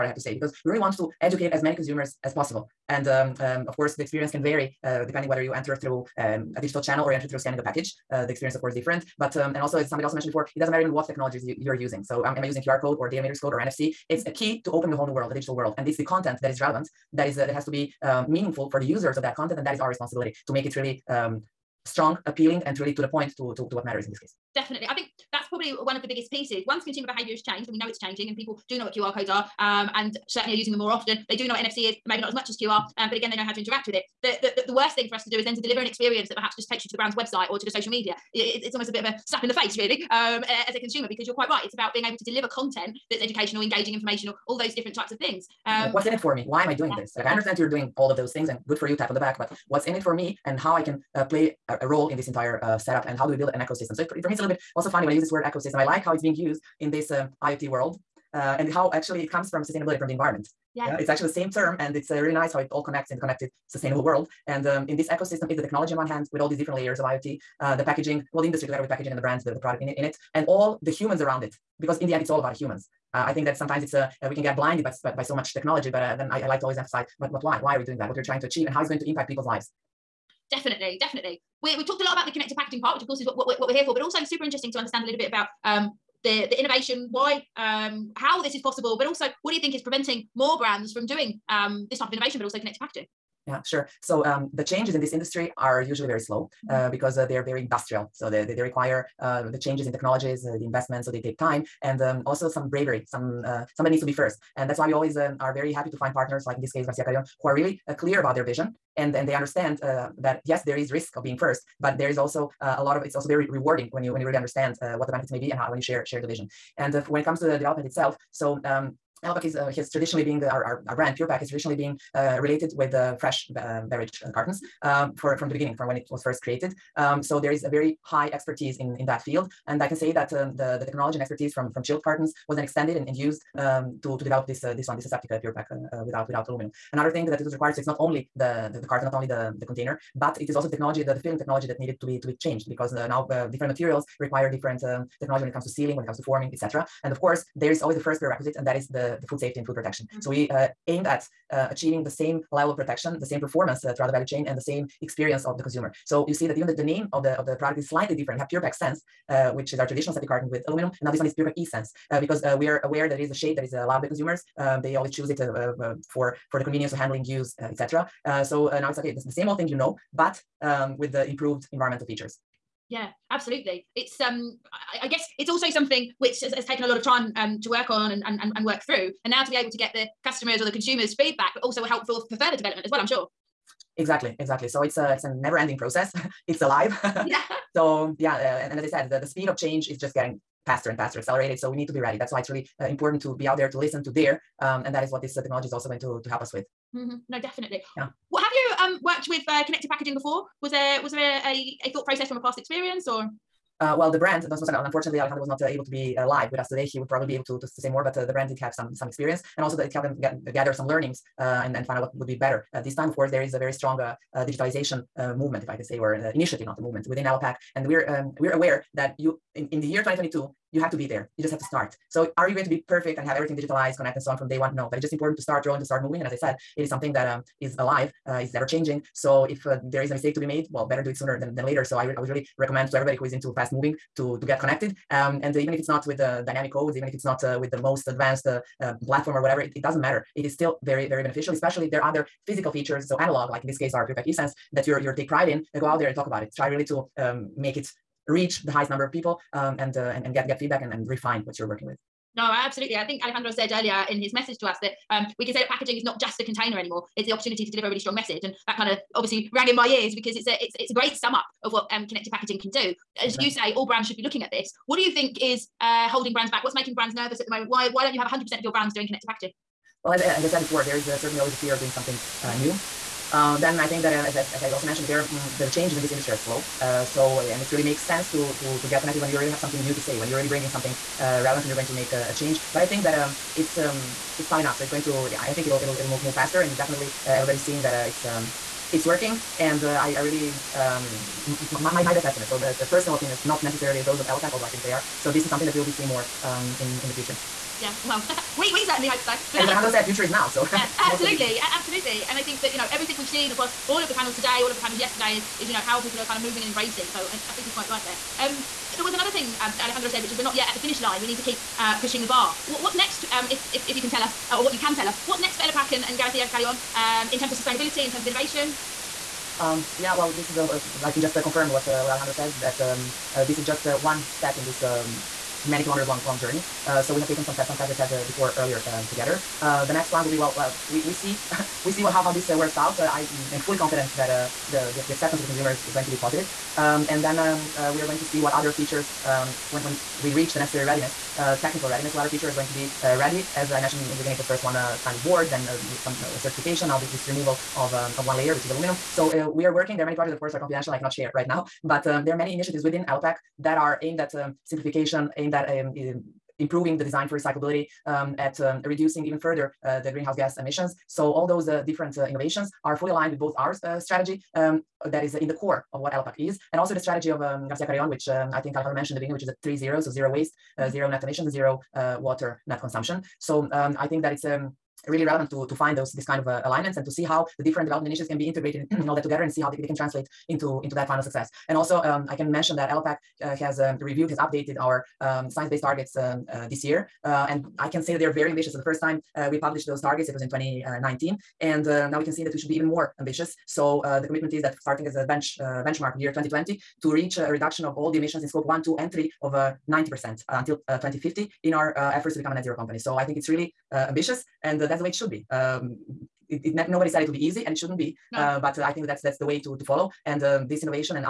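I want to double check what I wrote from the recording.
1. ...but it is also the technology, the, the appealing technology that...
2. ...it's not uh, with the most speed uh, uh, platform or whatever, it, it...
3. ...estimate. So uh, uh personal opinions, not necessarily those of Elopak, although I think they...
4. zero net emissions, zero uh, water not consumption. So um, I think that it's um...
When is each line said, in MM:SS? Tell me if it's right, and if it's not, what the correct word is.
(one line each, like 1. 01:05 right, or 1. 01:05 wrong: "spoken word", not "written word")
1. 02:20 wrong: "filling", not "appealing"
2. 03:57 wrong: "advanced", not "speed"
3. 04:52 right
4. 06:10 right.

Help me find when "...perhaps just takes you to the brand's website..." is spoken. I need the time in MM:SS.
00:36.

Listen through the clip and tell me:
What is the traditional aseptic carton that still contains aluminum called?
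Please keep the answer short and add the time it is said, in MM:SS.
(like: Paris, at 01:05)
Pure-Pak Sense, at 02:38.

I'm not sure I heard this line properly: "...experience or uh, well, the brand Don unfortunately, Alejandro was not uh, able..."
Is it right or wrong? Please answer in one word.
right.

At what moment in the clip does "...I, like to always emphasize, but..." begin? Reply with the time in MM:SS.
01:16.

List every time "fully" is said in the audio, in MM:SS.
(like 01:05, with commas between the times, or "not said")
05:33, 06:02.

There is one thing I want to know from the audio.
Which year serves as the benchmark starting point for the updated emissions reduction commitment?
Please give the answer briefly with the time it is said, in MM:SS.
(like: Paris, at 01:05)
2020, at 06:36.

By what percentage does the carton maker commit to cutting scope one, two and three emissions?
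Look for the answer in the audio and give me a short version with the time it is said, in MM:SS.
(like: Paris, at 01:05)
90%, at 06:39.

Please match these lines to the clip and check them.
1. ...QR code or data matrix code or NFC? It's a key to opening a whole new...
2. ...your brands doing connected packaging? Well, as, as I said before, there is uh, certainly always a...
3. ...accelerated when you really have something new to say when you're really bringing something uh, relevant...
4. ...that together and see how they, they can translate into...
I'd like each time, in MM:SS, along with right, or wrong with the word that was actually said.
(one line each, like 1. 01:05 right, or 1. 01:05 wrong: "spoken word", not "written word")
1. 00:12 right
2. 04:28 right
3. 04:39 wrong: "connected", not "accelerated"
4. 06:19 right.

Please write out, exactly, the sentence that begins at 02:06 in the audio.
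Um, so there is a very high expertise in, in that field.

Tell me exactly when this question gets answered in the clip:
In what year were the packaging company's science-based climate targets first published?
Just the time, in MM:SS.
06:30.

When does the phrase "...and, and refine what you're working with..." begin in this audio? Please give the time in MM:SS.
04:10.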